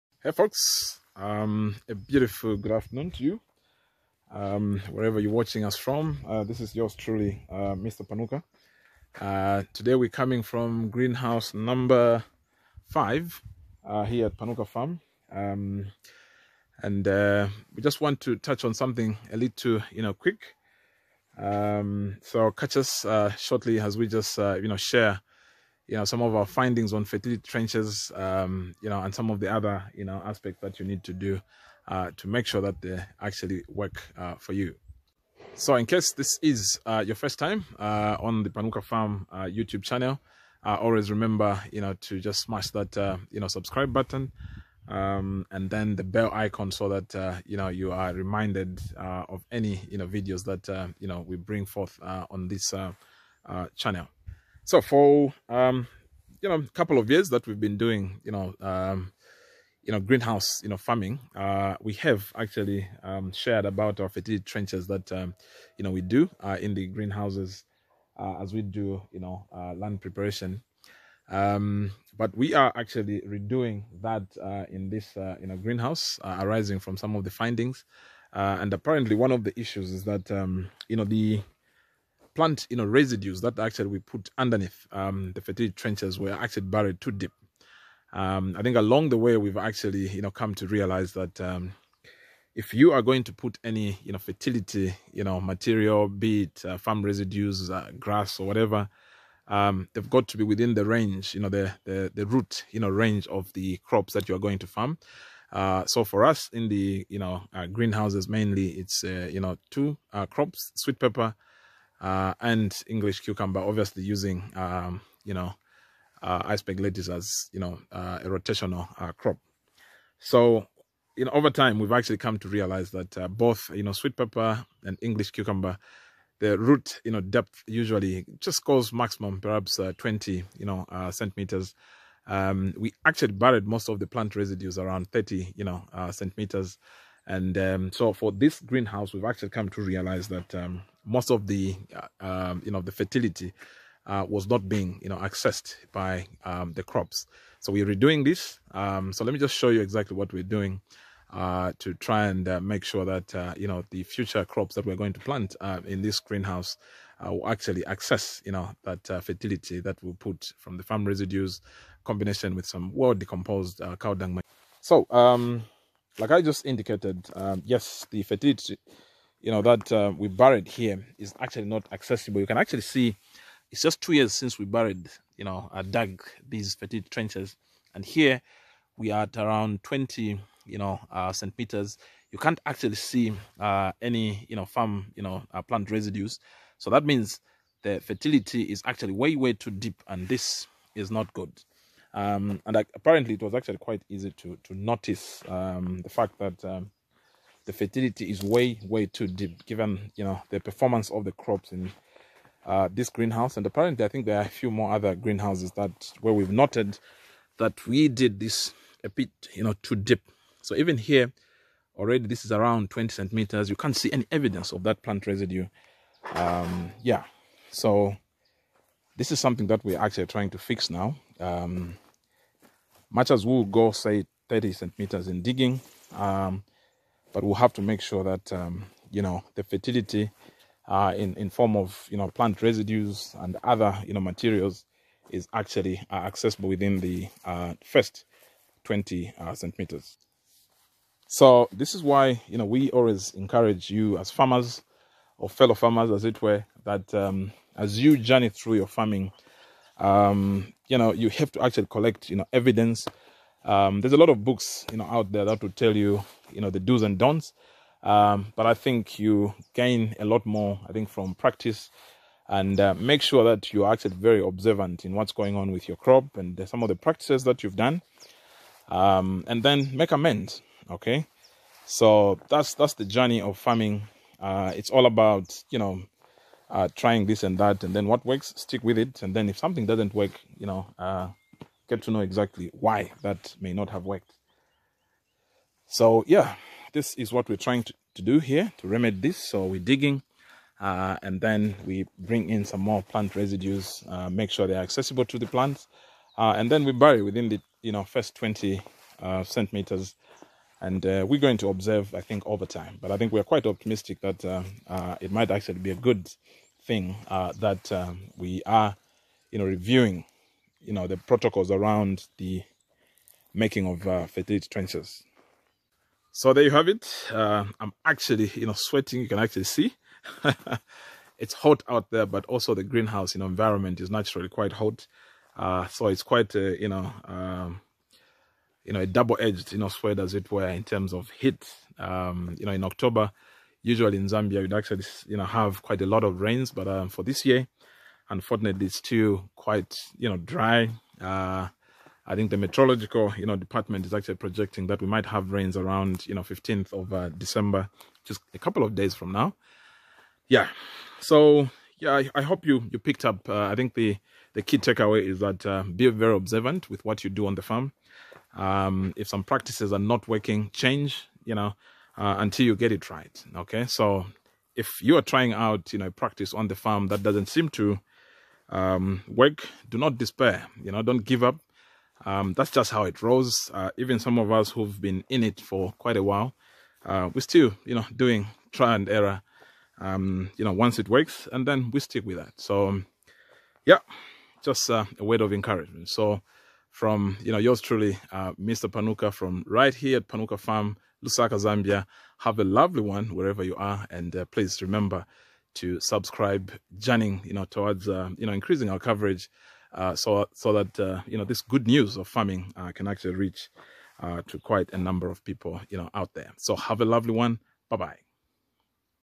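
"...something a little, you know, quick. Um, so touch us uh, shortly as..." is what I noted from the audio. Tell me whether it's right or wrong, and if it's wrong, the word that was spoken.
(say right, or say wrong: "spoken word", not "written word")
wrong: "catch", not "touch".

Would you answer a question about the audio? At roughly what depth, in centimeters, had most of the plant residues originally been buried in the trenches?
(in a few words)
30 centimeters.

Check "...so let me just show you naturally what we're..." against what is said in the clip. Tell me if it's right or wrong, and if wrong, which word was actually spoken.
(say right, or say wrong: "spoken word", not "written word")
wrong: "exactly", not "naturally".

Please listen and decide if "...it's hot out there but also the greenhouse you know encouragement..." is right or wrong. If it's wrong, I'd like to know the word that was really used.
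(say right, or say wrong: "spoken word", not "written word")
wrong: "environment", not "encouragement".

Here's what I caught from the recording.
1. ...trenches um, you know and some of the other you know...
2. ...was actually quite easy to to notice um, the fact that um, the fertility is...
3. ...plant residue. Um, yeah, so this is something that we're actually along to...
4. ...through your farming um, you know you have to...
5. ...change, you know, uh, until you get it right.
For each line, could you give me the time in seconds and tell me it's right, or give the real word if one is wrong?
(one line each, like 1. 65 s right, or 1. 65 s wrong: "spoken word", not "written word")
1. 27 s right
2. 193 s right
3. 215 s wrong: "trying", not "along"
4. 248 s right
5. 360 s right.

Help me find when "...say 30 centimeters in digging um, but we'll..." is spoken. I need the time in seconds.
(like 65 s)
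223 s.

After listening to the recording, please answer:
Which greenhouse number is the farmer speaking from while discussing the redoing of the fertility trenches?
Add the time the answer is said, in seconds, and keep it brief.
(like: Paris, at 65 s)
5, at 10 s.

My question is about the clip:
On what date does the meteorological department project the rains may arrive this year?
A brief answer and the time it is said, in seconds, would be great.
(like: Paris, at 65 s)
15 December, at 346 s.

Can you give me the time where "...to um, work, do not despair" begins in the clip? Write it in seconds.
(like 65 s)
367 s.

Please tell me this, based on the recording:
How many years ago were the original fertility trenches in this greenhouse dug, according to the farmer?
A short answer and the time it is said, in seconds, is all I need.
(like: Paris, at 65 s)
2 years, at 174 s.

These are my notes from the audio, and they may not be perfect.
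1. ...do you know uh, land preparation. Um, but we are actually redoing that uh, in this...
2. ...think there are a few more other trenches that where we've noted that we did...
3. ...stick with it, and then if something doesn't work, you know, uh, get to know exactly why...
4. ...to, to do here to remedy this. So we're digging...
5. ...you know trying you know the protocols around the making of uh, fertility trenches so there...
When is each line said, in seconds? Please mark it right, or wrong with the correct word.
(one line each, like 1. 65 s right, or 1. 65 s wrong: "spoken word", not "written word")
1. 68 s right
2. 204 s wrong: "greenhouses", not "trenches"
3. 278 s right
4. 287 s right
5. 309 s wrong: "reviewing", not "trying".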